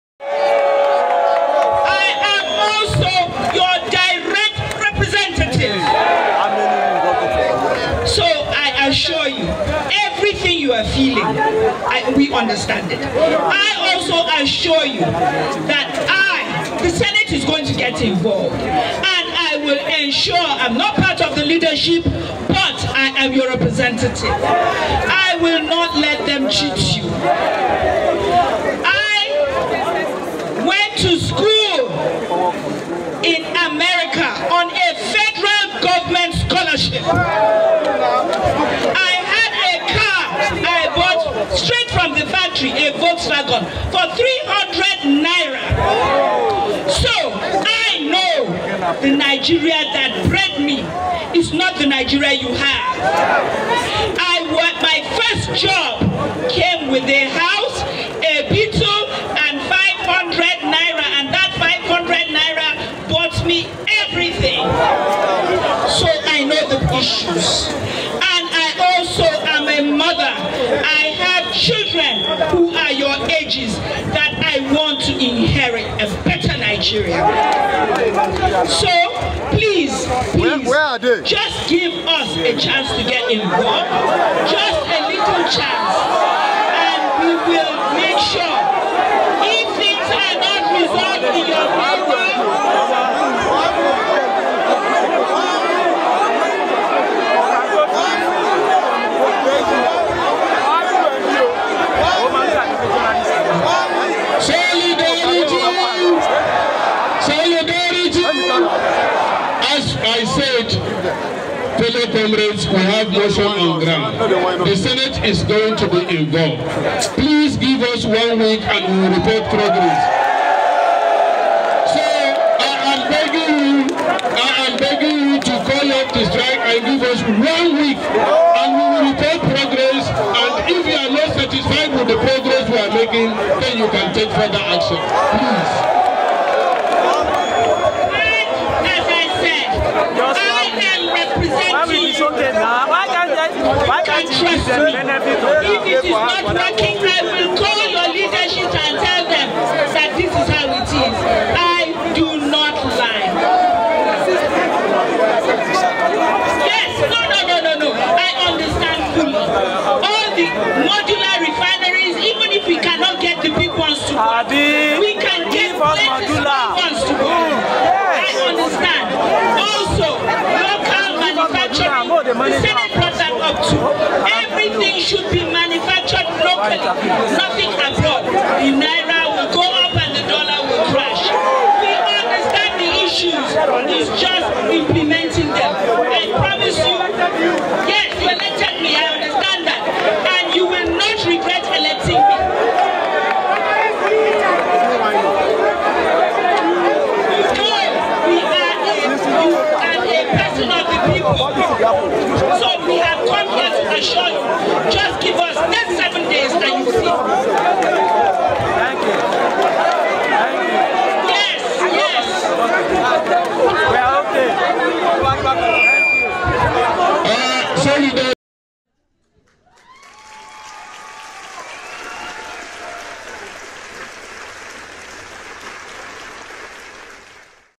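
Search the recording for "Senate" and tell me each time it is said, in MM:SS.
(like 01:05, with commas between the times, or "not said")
00:16, 01:54.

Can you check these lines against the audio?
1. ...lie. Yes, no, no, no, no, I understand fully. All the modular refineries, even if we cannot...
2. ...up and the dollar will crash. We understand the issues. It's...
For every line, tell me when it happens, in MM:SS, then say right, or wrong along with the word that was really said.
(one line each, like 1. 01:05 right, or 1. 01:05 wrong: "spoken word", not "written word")
1. 02:32 right
2. 02:59 right.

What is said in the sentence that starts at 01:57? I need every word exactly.
Please give us one week and we will report progress.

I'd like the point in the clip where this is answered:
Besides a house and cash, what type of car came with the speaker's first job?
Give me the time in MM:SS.
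00:58.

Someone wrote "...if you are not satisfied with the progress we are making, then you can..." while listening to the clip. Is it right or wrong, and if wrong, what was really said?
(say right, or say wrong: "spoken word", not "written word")
right.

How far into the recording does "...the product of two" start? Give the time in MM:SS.
02:52.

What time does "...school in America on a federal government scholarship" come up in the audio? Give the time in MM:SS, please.
00:31.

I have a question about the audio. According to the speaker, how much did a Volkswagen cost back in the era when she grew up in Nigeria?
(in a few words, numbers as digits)
300 naira.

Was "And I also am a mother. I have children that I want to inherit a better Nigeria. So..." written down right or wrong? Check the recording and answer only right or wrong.
right.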